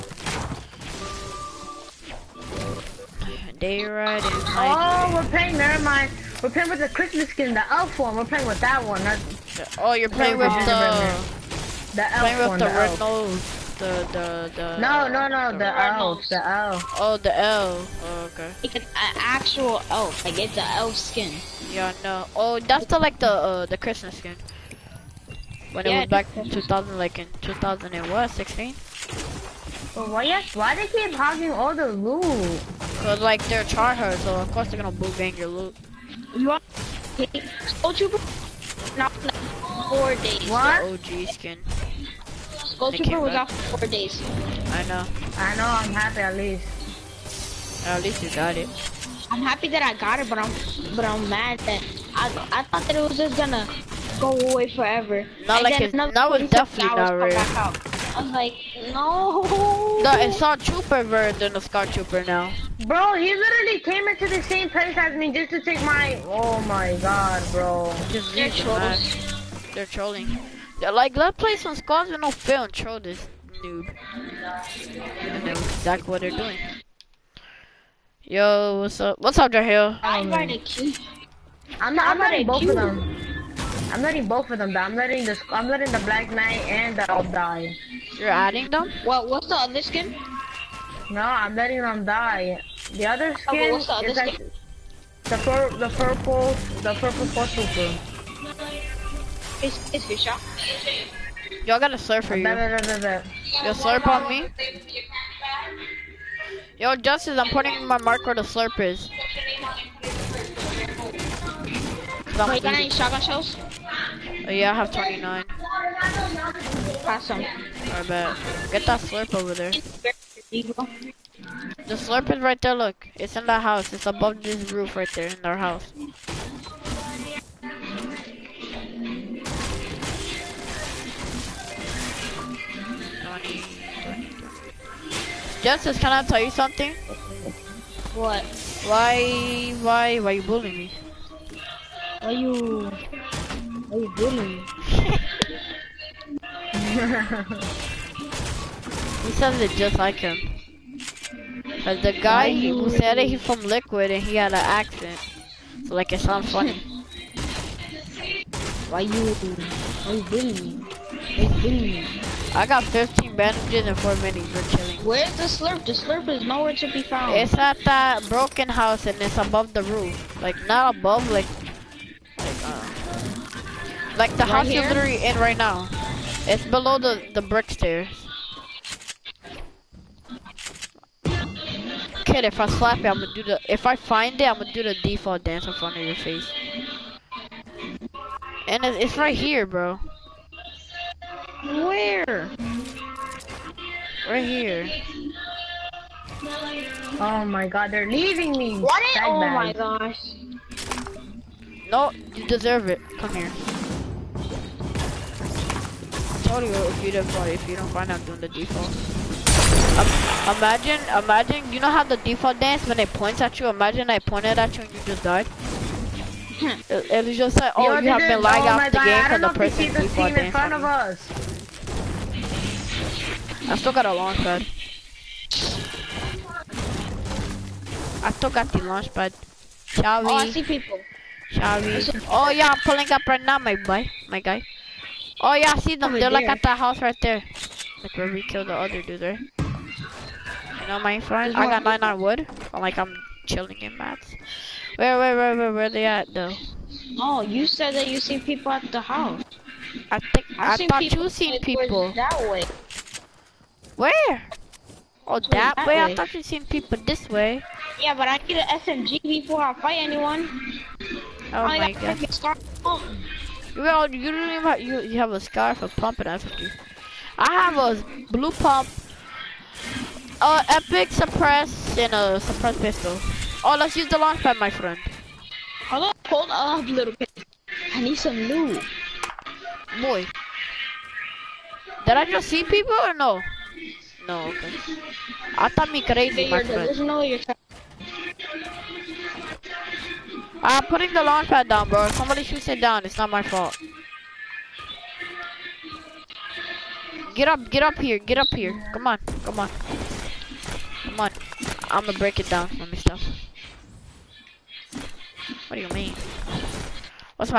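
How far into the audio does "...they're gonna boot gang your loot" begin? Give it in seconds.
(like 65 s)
34 s.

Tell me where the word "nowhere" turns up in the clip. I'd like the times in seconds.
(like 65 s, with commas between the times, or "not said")
166 s.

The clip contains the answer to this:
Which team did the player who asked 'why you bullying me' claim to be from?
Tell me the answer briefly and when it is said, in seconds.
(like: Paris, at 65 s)
Liquid, at 153 s.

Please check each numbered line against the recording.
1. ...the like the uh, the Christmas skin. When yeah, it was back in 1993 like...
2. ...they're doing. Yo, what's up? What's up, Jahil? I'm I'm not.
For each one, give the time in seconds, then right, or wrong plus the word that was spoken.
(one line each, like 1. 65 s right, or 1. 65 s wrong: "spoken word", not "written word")
1. 22 s wrong: "2000", not "1993"
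2. 76 s right.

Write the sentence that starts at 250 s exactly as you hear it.
I think I've I thought you seen people.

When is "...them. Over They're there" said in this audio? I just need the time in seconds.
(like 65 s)
235 s.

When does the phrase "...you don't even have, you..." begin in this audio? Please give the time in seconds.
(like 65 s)
264 s.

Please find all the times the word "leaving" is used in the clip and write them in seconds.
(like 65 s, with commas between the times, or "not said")
198 s.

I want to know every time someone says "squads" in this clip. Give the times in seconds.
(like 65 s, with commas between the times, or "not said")
71 s.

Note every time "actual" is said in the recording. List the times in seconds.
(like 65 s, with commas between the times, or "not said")
19 s.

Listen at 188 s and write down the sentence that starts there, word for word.
And it's, it's right here, bro.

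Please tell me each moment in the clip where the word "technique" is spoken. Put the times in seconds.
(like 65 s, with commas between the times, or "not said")
not said.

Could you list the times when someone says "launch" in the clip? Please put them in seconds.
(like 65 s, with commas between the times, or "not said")
224 s, 228 s, 274 s, 291 s.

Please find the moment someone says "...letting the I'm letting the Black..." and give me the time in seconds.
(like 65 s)
84 s.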